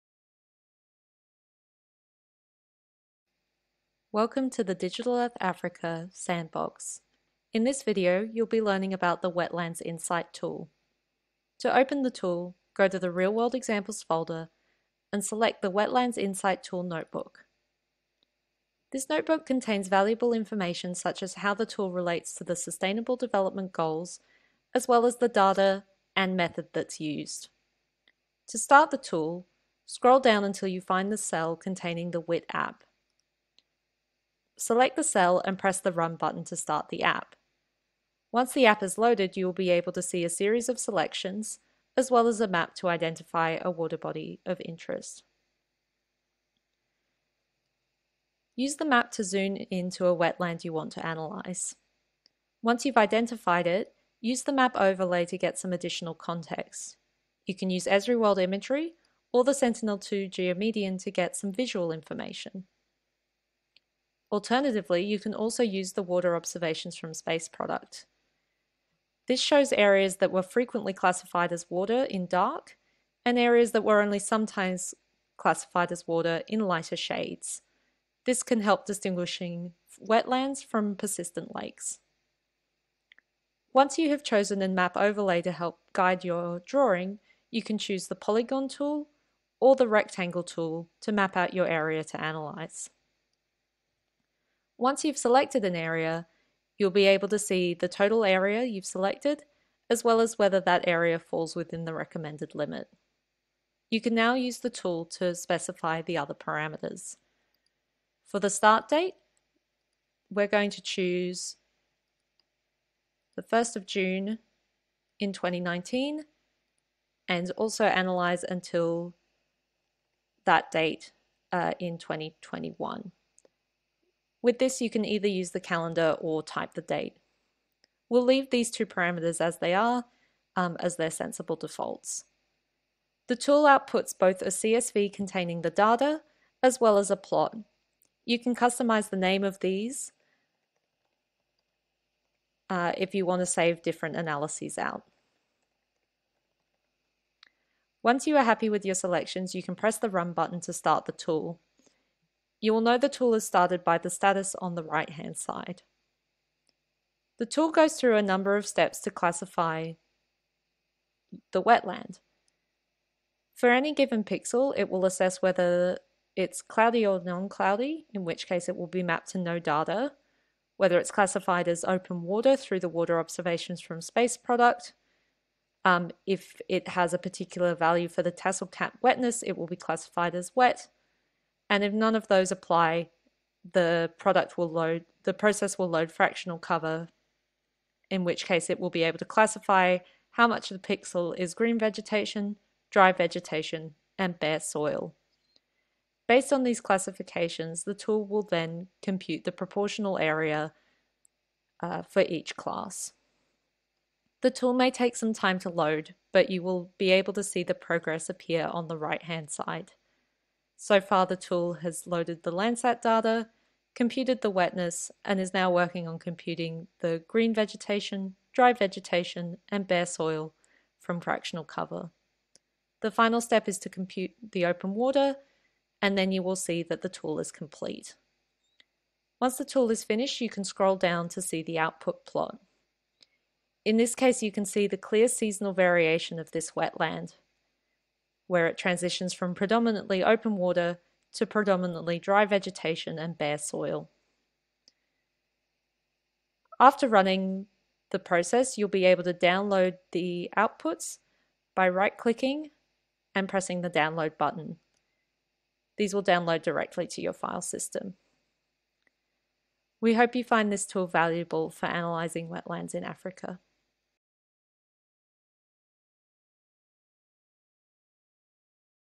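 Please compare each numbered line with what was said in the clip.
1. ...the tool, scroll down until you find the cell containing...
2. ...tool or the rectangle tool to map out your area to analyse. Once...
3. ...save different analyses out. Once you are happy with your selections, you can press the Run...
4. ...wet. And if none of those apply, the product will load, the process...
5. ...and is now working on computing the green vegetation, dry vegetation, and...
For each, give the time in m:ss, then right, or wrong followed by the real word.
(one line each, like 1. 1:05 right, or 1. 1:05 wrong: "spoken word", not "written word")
1. 0:28 right
2. 1:28 right
3. 2:23 right
4. 3:00 right
5. 3:35 right.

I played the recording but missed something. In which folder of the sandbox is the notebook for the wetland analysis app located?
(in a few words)
Real World Examples.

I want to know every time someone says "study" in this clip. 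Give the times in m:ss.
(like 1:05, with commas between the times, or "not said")
not said.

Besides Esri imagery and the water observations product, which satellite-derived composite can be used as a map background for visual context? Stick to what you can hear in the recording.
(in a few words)
Sentinel-2 Geomedian.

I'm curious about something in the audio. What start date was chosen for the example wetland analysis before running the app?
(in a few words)
1 June 2019.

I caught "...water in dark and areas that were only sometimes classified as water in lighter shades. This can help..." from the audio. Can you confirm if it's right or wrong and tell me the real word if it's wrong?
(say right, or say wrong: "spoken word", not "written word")
right.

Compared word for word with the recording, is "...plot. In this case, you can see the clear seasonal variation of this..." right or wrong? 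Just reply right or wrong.
right.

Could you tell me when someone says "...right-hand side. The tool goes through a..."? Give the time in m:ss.
2:34.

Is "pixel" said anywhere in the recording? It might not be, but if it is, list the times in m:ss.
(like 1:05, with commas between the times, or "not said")
2:44, 3:10.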